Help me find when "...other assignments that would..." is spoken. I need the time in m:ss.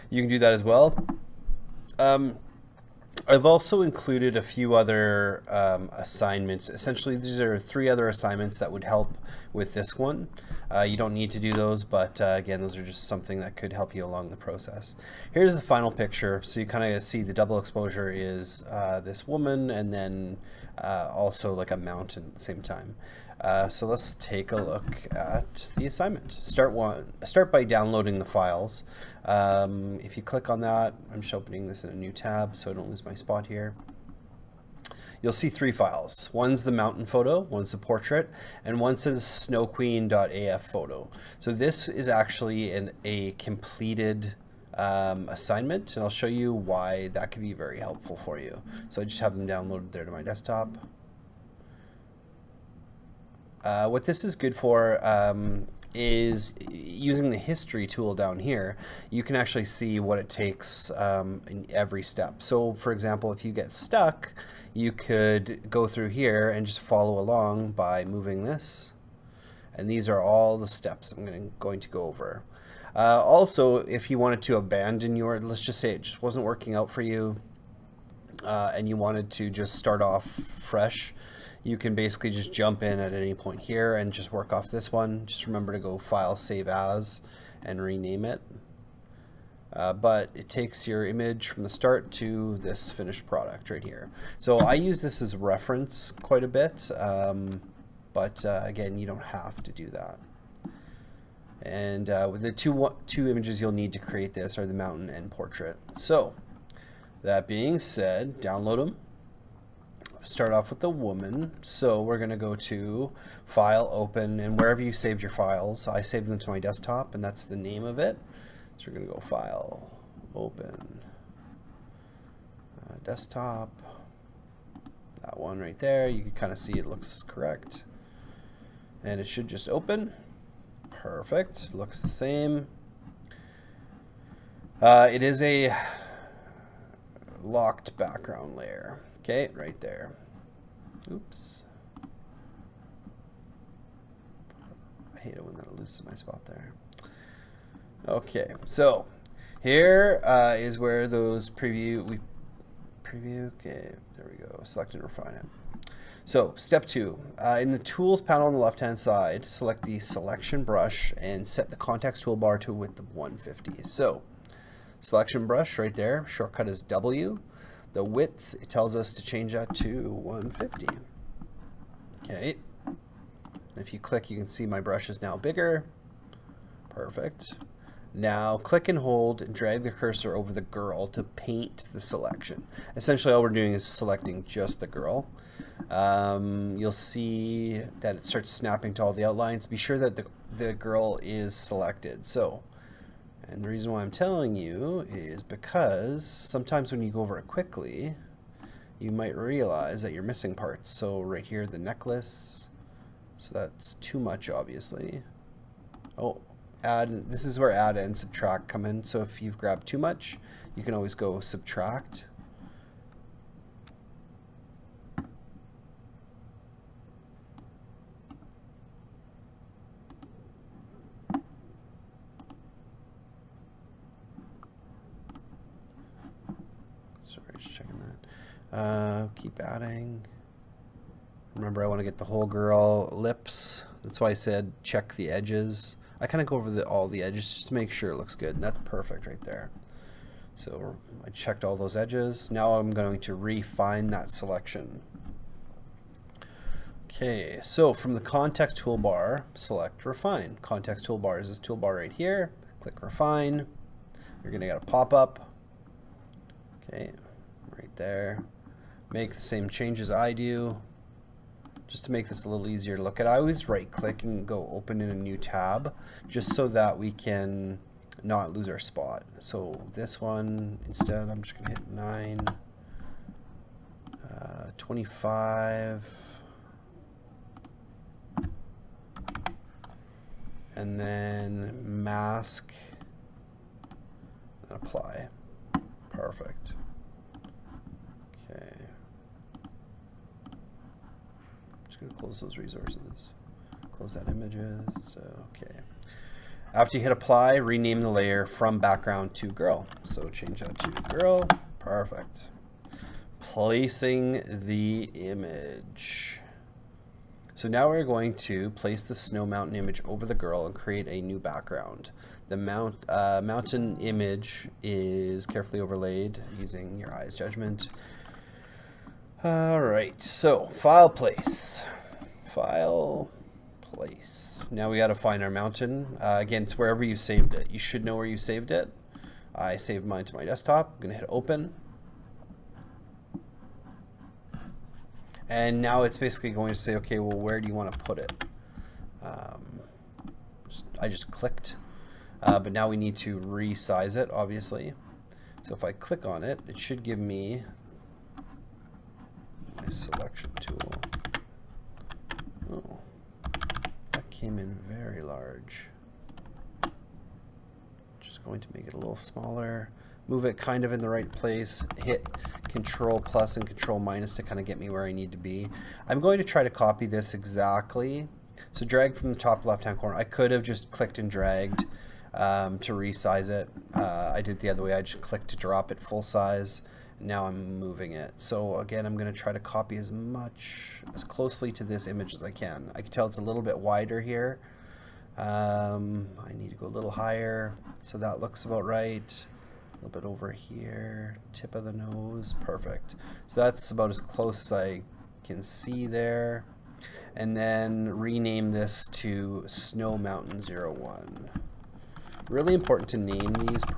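0:07.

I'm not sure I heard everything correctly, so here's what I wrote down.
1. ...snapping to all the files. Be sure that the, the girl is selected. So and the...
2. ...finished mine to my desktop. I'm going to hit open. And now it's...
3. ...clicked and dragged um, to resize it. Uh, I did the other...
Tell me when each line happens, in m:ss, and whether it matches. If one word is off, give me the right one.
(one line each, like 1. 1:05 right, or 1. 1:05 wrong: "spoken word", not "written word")
1. 3:08 wrong: "outlines", not "files"
2. 5:29 wrong: "saved", not "finished"
3. 6:10 right.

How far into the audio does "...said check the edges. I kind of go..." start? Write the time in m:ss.
3:54.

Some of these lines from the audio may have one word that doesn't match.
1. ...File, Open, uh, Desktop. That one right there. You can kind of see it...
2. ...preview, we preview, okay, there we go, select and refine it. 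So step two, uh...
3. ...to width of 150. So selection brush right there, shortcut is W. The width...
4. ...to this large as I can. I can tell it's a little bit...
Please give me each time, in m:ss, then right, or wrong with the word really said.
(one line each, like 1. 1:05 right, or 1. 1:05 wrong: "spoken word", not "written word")
1. 1:59 right
2. 2:31 right
3. 2:42 right
4. 6:21 wrong: "image", not "large".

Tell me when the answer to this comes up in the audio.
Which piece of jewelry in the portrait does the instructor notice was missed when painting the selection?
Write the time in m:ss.
3:21.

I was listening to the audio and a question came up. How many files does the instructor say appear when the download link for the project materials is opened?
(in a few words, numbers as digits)
3.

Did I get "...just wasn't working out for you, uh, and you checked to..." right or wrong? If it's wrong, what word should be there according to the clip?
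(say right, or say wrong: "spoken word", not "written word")
wrong: "wanted", not "checked".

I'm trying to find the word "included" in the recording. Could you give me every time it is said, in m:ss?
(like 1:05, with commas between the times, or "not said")
0:03.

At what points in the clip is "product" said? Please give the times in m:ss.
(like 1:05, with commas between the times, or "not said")
1:33.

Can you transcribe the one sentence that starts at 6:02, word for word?
Hit control plus and control minus to kind of get me where I need to be.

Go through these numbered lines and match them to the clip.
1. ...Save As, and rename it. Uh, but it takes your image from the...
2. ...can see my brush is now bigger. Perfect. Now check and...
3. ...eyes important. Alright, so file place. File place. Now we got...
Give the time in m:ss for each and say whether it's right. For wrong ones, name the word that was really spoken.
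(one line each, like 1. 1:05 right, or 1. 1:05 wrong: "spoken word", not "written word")
1. 1:26 right
2. 2:54 wrong: "click", not "check"
3. 5:17 wrong: "judgment", not "important".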